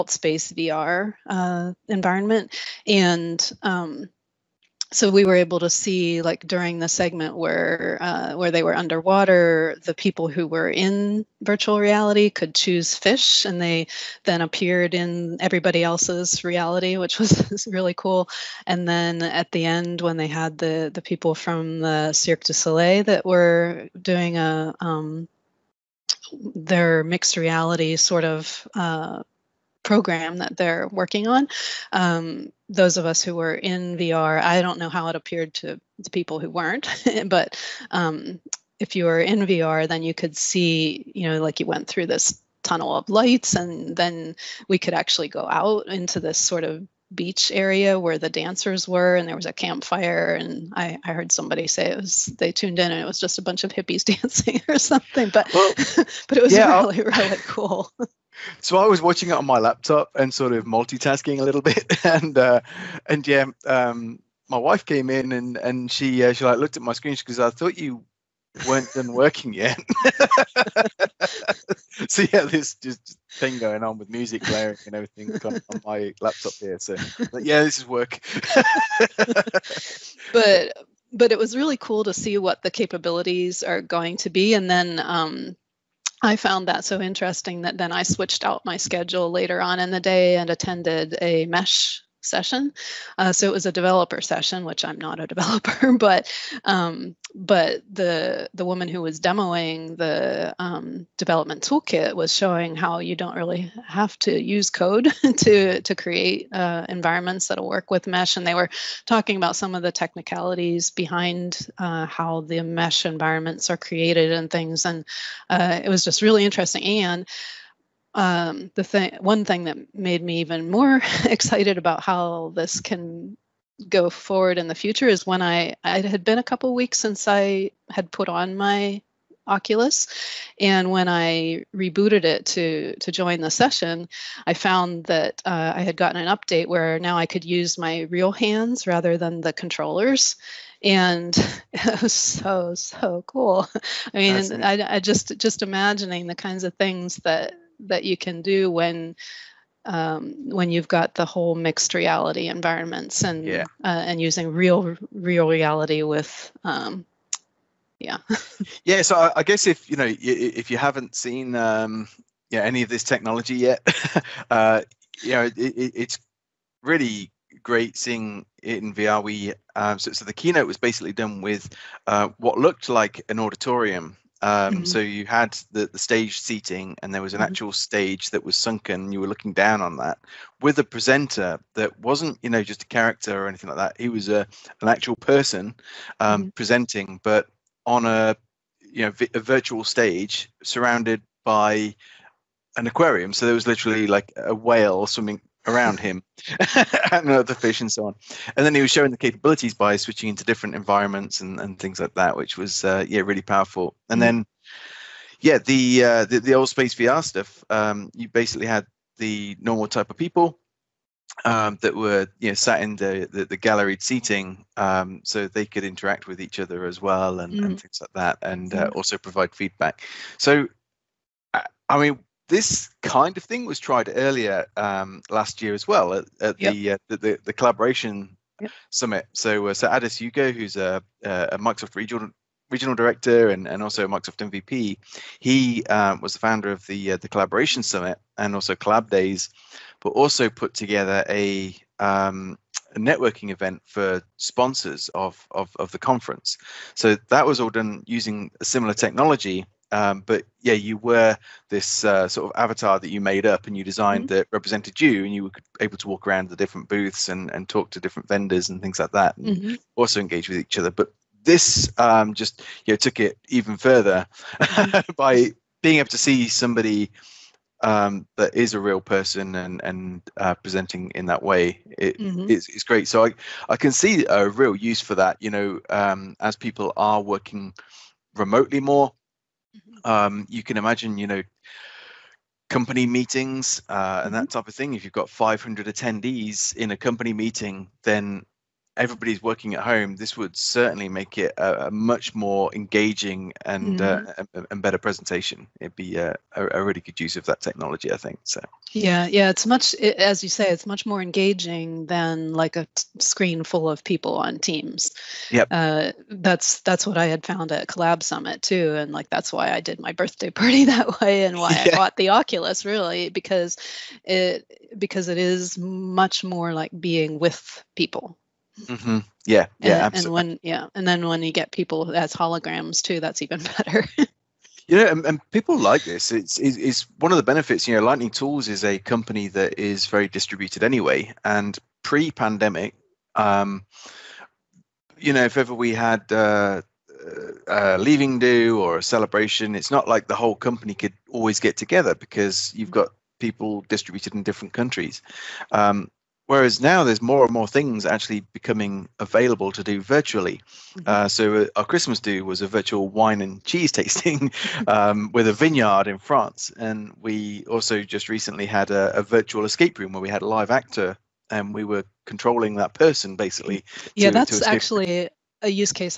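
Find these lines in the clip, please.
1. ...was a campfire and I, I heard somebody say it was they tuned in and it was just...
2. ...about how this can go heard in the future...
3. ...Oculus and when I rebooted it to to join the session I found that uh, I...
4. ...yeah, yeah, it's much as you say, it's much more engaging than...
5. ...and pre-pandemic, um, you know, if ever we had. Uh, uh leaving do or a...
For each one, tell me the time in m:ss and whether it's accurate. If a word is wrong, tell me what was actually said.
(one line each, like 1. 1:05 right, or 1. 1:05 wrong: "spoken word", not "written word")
1. 0:49 right
2. 2:01 wrong: "forward", not "heard"
3. 2:09 right
4. 4:58 right
5. 5:31 right.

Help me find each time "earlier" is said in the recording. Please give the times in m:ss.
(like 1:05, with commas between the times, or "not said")
3:44.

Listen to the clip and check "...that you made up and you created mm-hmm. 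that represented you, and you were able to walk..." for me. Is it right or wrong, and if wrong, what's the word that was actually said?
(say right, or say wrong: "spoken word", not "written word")
wrong: "designed", not "created".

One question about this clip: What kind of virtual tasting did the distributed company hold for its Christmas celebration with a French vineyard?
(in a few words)
Wine and cheese tasting.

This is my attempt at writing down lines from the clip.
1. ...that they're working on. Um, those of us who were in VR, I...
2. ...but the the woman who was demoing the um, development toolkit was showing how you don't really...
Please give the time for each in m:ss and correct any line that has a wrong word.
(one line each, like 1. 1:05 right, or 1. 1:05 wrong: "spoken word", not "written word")
1. 0:30 right
2. 1:37 right.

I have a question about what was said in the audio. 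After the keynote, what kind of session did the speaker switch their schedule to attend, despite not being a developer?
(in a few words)
Mesh session.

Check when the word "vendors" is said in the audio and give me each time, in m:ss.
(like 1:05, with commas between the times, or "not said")
4:18.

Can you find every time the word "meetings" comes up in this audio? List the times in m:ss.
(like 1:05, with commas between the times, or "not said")
4:43, 4:47.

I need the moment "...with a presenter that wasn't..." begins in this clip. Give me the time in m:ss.
3:00.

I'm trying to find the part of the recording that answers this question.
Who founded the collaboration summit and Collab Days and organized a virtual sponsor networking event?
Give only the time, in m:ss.
3:49.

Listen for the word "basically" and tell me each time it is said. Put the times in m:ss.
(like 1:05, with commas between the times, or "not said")
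2:50, 3:28, 6:03.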